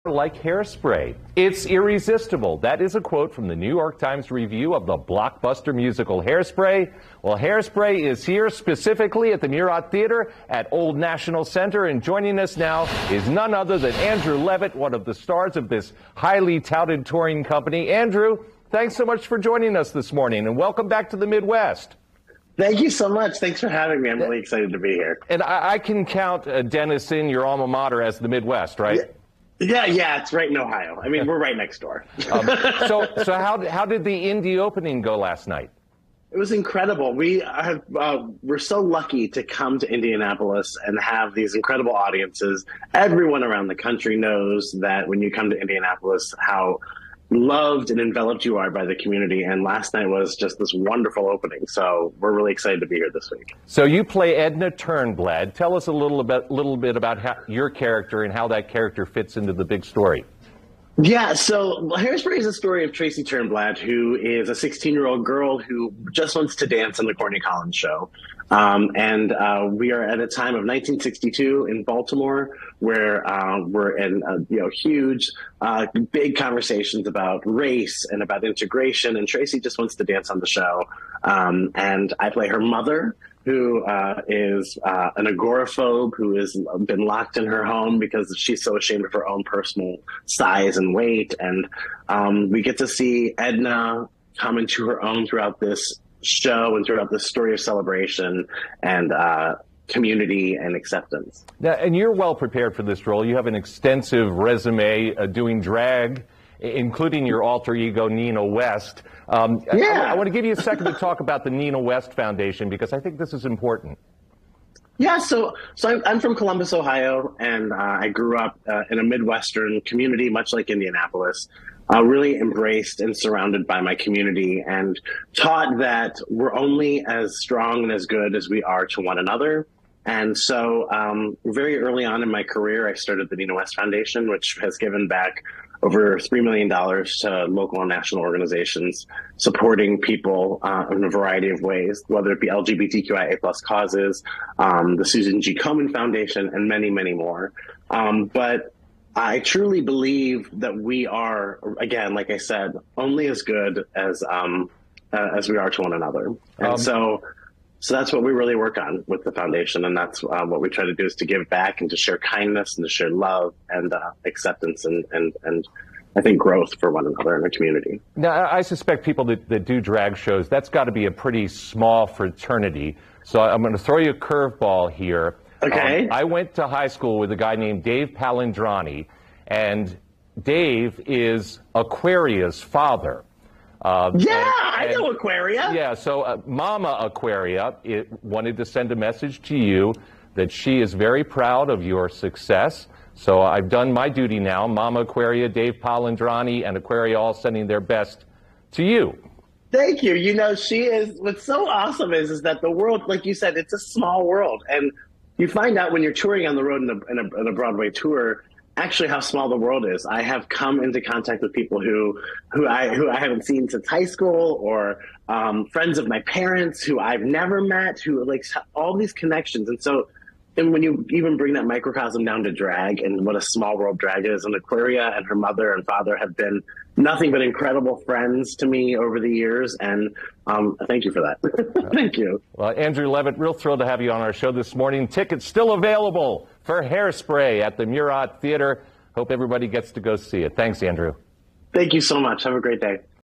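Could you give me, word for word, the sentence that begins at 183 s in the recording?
Uh, yeah, and, I know Aquaria.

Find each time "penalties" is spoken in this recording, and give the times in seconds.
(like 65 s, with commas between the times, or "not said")
not said.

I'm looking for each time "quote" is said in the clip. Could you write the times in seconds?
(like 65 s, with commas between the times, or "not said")
3 s.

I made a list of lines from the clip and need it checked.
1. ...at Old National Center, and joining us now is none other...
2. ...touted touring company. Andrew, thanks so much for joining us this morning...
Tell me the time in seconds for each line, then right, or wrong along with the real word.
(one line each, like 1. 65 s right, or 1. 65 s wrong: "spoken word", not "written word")
1. 10 s right
2. 16 s right.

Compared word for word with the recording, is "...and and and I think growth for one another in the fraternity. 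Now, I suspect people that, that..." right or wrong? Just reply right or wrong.
wrong.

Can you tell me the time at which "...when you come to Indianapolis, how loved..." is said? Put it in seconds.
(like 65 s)
45 s.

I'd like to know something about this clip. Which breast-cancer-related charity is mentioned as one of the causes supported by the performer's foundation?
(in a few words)
Susan G. Komen Foundation.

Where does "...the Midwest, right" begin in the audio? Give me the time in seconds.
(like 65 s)
28 s.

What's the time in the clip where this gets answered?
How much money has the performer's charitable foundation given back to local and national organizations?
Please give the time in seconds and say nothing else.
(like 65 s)
136 s.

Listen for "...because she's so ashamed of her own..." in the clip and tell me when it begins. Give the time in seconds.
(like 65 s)
87 s.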